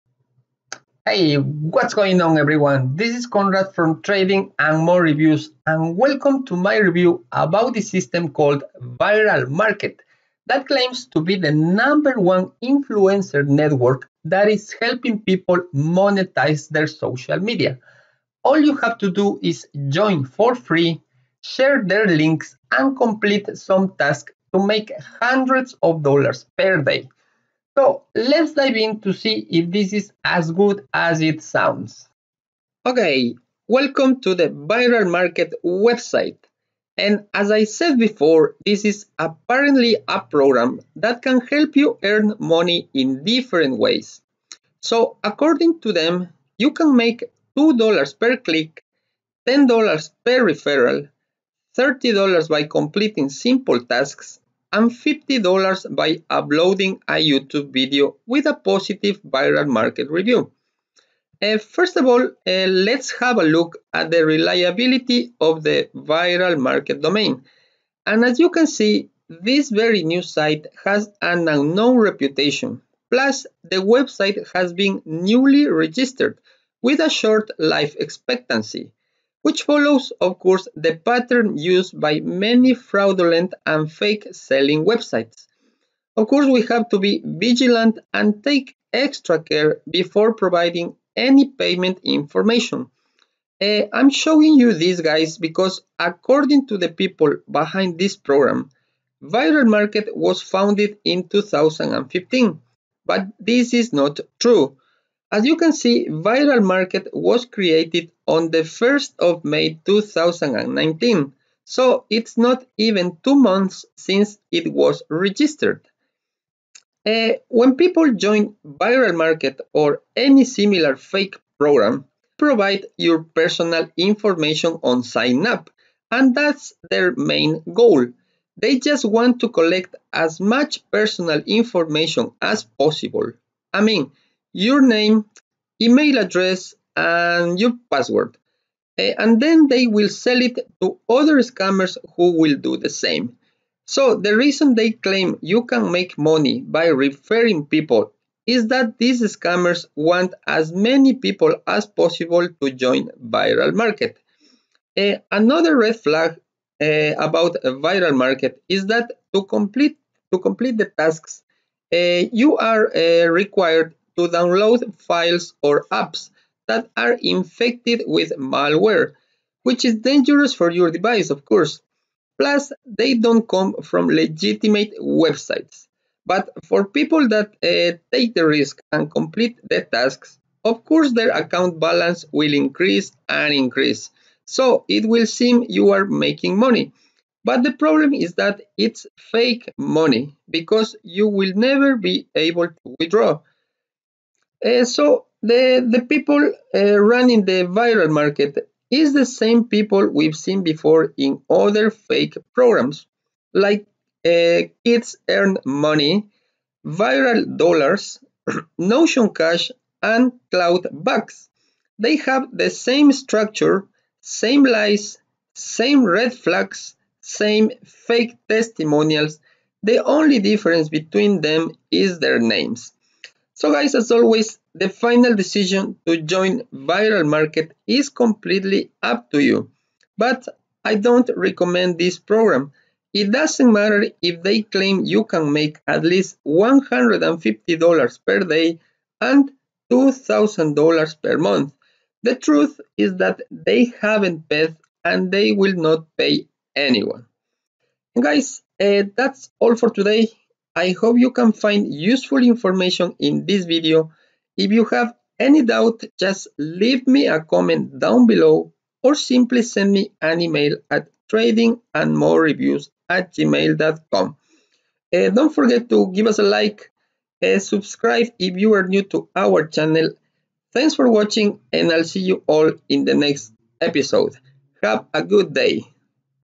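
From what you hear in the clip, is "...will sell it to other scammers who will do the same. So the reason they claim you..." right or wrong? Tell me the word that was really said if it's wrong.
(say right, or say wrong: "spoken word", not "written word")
right.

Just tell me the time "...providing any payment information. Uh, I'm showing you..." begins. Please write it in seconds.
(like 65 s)
90 s.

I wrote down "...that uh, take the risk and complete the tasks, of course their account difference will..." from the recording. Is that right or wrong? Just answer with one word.
wrong.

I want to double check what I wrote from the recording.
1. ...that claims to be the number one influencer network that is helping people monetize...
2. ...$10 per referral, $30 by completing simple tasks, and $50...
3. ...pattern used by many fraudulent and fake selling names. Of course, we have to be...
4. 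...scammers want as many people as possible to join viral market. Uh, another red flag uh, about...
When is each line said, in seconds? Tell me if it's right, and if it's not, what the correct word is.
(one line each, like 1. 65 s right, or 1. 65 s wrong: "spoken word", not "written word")
1. 10 s right
2. 49 s right
3. 80 s wrong: "websites", not "names"
4. 149 s right.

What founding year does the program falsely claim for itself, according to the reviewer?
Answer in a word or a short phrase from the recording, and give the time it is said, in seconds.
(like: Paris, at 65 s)
2015, at 101 s.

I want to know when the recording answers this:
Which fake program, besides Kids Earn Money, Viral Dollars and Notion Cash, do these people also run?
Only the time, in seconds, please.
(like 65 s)
210 s.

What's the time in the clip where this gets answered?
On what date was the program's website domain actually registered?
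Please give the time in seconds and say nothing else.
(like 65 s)
108 s.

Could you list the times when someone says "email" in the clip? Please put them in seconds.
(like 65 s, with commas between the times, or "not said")
135 s, 260 s.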